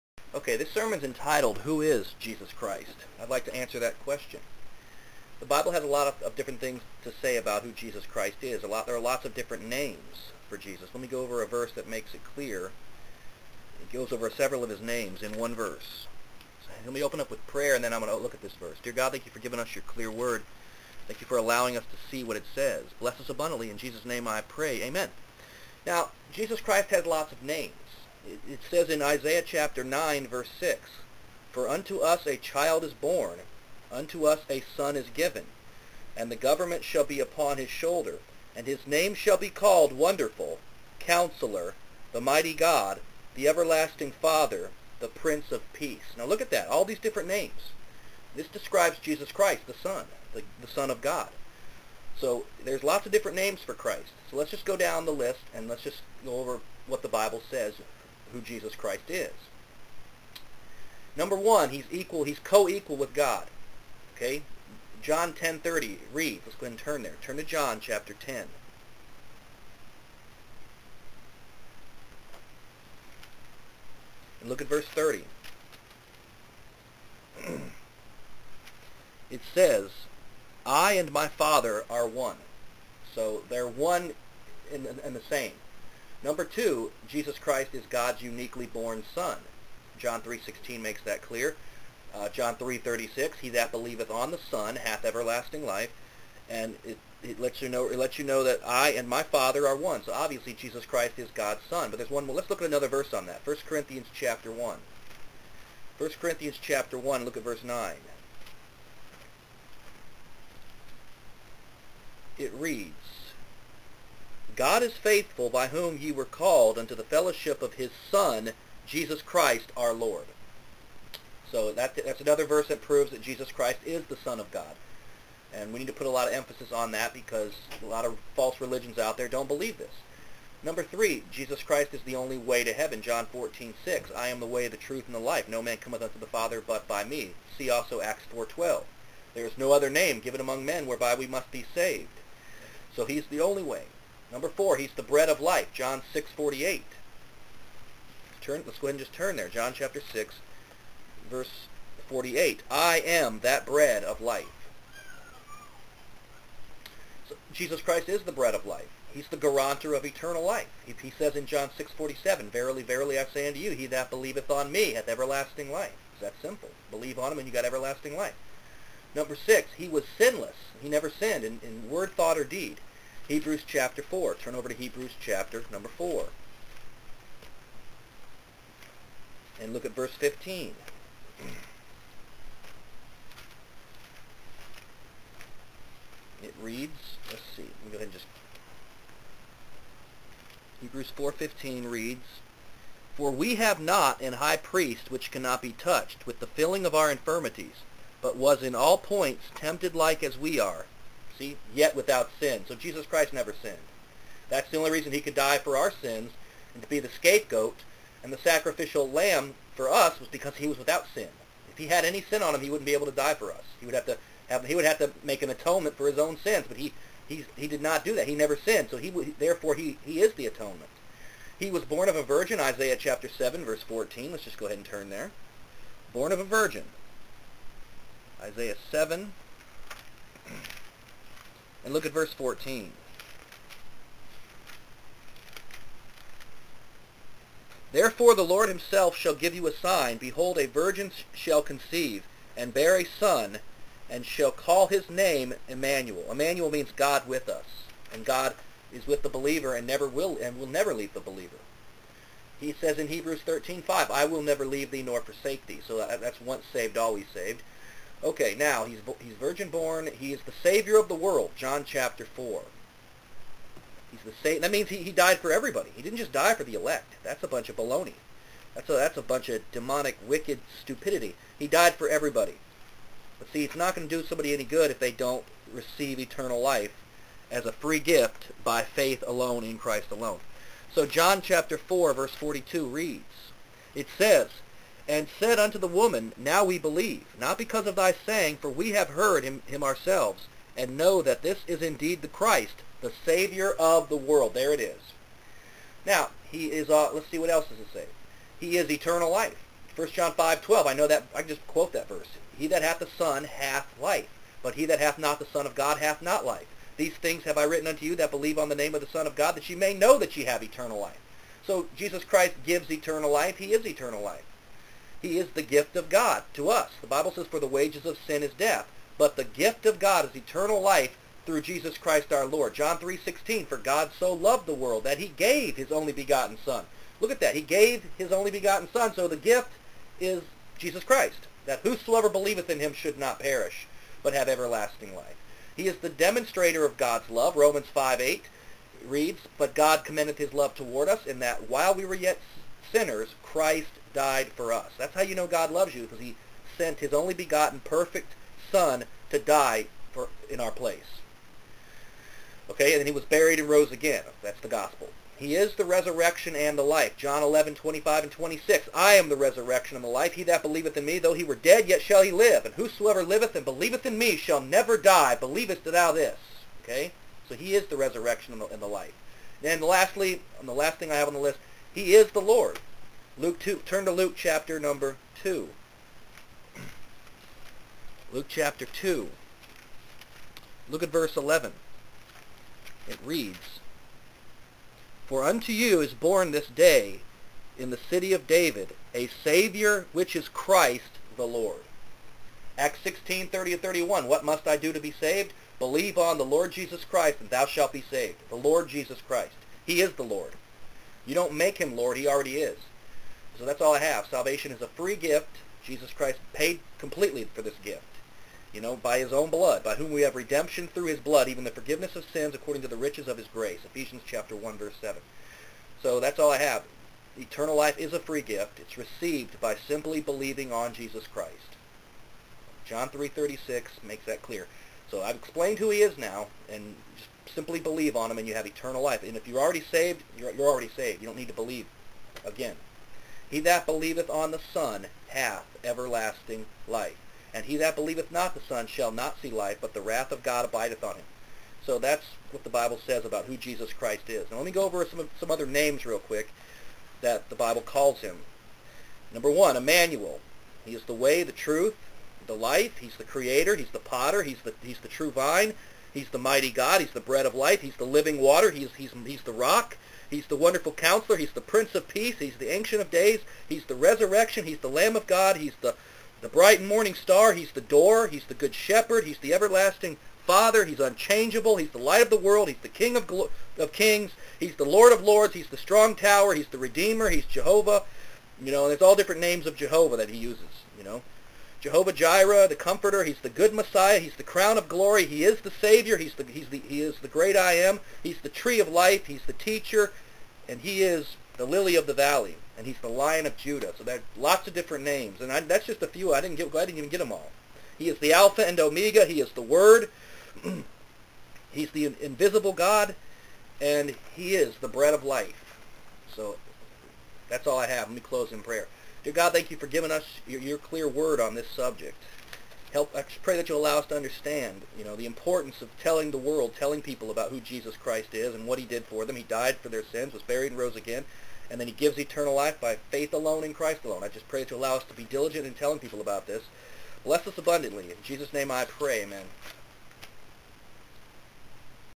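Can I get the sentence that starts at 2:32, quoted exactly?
I am that bread of life.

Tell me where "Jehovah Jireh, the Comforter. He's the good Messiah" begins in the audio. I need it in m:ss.
8:01.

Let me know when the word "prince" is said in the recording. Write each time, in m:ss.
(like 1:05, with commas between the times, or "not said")
0:45, 7:41.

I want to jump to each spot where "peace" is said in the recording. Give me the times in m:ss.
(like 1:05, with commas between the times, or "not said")
0:45, 7:42.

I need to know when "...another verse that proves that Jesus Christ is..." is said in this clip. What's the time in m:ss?
2:02.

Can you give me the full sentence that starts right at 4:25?
He didn't just die for the elect.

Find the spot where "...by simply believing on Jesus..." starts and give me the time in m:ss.
6:59.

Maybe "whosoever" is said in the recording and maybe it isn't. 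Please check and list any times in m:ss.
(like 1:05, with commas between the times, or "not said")
5:31, 6:02.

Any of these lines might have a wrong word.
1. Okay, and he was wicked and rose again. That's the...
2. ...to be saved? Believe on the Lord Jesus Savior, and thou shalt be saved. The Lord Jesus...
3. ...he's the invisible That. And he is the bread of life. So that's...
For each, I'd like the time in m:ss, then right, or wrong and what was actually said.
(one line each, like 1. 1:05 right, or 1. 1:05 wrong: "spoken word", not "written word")
1. 5:52 wrong: "buried", not "wicked"
2. 6:34 wrong: "Christ", not "Savior"
3. 8:21 wrong: "God", not "That".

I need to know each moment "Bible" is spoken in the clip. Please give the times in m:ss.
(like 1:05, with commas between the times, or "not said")
0:05, 0:57, 5:17, 7:22, 7:27.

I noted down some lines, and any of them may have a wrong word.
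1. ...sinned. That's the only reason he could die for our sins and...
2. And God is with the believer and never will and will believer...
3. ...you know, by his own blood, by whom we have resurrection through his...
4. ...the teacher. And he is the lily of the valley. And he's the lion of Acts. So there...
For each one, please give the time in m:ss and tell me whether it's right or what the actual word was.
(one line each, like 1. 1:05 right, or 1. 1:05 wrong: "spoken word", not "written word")
1. 3:23 right
2. 4:08 wrong: "never", not "believer"
3. 6:48 wrong: "redemption", not "resurrection"
4. 8:09 wrong: "Judah", not "Acts".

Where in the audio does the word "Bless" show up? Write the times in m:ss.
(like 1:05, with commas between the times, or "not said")
0:22, 8:47.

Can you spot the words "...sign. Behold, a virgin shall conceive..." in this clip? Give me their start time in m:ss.
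3:59.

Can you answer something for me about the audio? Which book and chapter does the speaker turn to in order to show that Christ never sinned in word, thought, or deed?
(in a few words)
Hebrews 4.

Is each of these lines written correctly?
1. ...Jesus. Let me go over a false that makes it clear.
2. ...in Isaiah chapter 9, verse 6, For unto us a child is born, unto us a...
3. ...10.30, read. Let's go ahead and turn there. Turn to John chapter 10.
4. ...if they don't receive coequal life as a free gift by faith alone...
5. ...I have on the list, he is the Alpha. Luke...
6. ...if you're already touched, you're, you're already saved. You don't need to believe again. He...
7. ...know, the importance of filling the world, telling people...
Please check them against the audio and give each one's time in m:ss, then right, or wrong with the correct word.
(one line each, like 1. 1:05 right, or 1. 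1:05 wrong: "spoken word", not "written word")
1. 0:10 wrong: "verse", not "false"
2. 0:28 right
3. 1:05 right
4. 4:34 wrong: "eternal", not "coequal"
5. 6:11 wrong: "Lord", not "Alpha"
6. 7:09 wrong: "saved", not "touched"
7. 8:35 wrong: "telling", not "filling".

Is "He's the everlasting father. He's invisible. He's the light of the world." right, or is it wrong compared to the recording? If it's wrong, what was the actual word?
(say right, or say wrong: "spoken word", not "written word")
wrong: "unchangeable", not "invisible".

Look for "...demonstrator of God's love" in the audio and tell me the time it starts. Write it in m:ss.
5:36.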